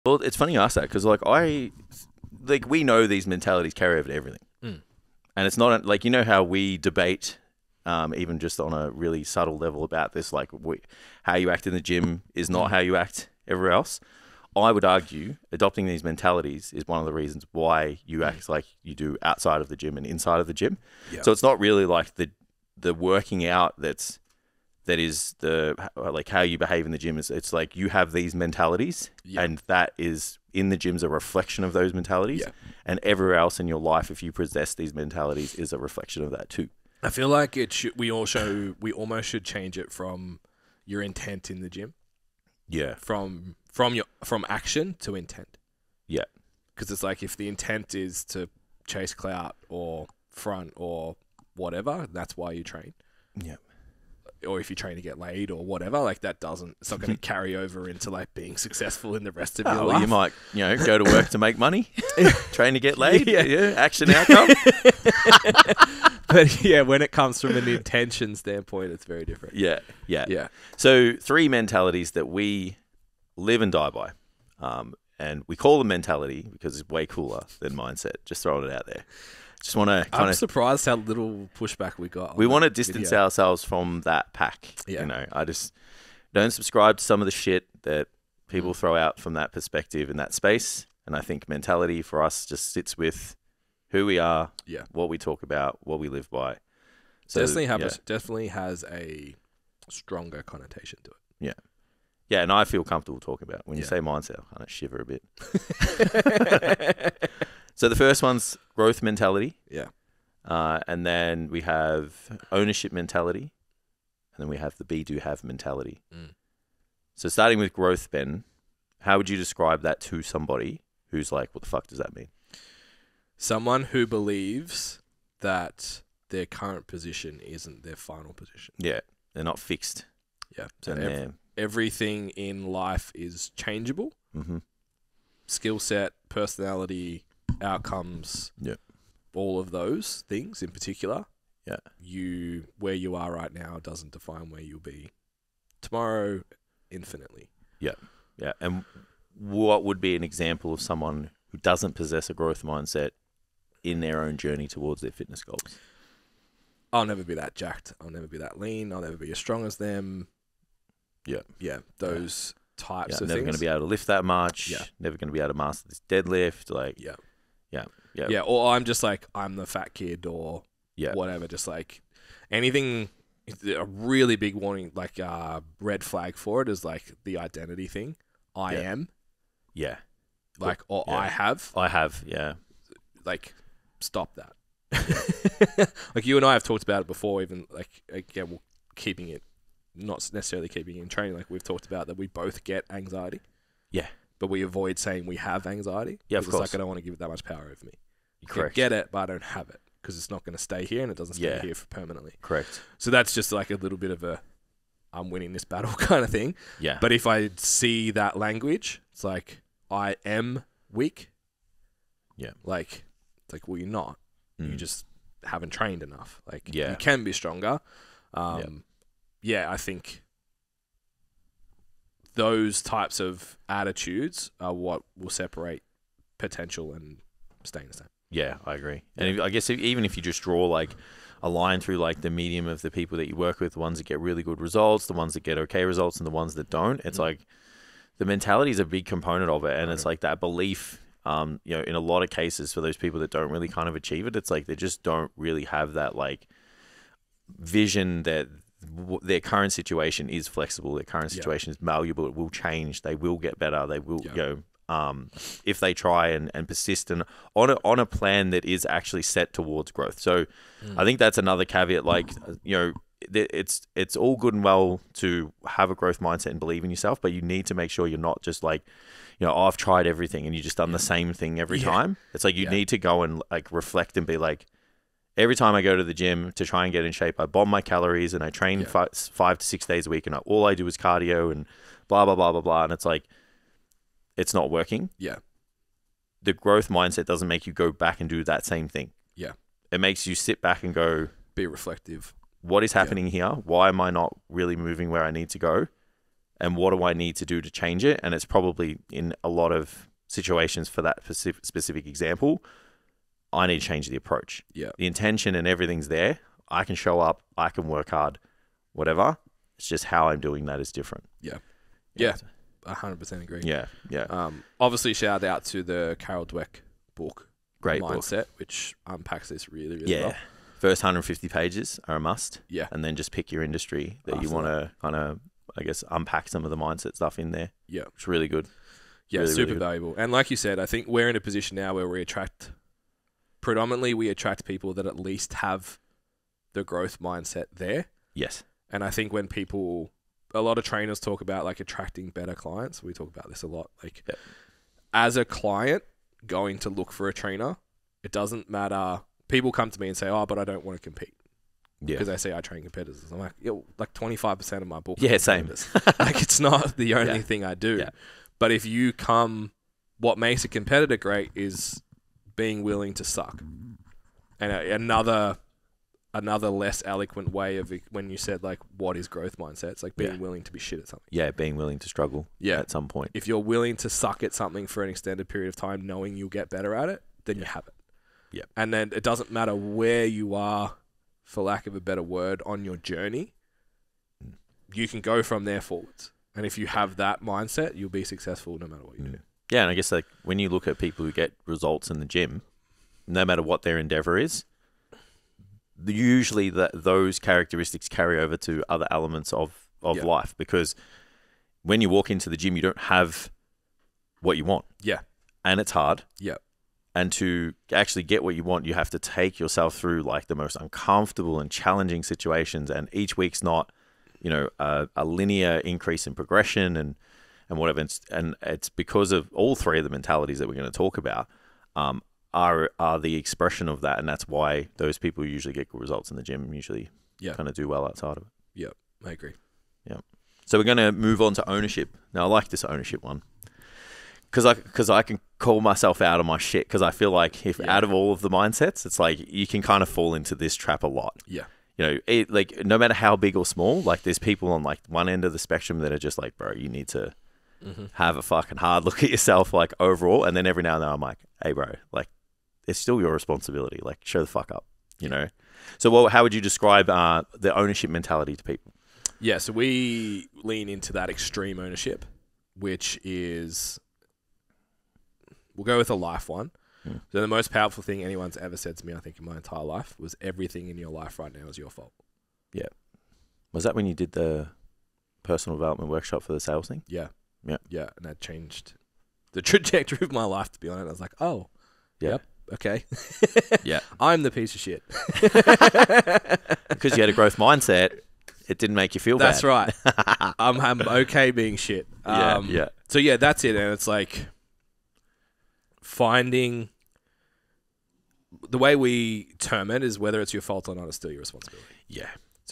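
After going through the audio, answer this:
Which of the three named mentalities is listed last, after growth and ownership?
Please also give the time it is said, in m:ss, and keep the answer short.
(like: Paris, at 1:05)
be do have mentality, at 1:54.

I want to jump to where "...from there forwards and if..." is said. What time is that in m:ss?
6:25.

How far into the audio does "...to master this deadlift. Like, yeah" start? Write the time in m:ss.
2:45.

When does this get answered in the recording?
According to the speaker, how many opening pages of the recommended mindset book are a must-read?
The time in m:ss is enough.
5:21.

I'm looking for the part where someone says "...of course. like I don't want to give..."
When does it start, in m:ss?
3:16.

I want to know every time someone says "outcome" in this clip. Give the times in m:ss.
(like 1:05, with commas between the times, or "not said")
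1:04, 2:17.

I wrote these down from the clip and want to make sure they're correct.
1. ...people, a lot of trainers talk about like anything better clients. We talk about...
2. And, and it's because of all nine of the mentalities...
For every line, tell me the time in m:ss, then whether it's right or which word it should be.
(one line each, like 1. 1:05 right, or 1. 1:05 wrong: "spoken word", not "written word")
1. 5:39 wrong: "attracting", not "anything"
2. 6:58 wrong: "three", not "nine".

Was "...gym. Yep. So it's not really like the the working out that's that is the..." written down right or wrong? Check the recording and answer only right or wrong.
right.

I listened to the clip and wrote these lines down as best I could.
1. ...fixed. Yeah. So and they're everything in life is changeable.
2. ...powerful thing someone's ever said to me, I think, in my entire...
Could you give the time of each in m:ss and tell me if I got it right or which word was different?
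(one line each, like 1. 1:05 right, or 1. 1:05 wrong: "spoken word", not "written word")
1. 2:09 right
2. 7:47 wrong: "anyone", not "someone".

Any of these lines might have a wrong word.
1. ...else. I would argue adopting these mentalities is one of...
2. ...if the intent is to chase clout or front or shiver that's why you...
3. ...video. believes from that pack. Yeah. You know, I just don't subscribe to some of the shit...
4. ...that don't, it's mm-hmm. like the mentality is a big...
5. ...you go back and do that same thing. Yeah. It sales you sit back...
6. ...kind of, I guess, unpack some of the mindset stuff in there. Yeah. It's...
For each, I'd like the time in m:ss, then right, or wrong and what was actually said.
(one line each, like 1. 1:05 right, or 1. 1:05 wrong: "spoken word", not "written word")
1. 0:13 right
2. 0:47 wrong: "whatever", not "shiver"
3. 1:23 wrong: "ourselves", not "believes"
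4. 3:56 right
5. 4:47 wrong: "makes", not "sales"
6. 5:25 right.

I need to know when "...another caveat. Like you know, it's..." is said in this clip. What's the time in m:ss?
4:21.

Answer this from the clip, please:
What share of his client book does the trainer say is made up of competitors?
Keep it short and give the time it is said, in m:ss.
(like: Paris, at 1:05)
25%, at 5:54.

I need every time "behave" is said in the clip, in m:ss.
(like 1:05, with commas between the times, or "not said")
0:26.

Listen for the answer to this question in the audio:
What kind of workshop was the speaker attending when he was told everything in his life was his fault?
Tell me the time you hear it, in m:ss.
7:55.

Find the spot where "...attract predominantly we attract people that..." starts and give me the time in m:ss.
5:32.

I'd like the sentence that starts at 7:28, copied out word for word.
have a fucking hard look at yourself, like overall.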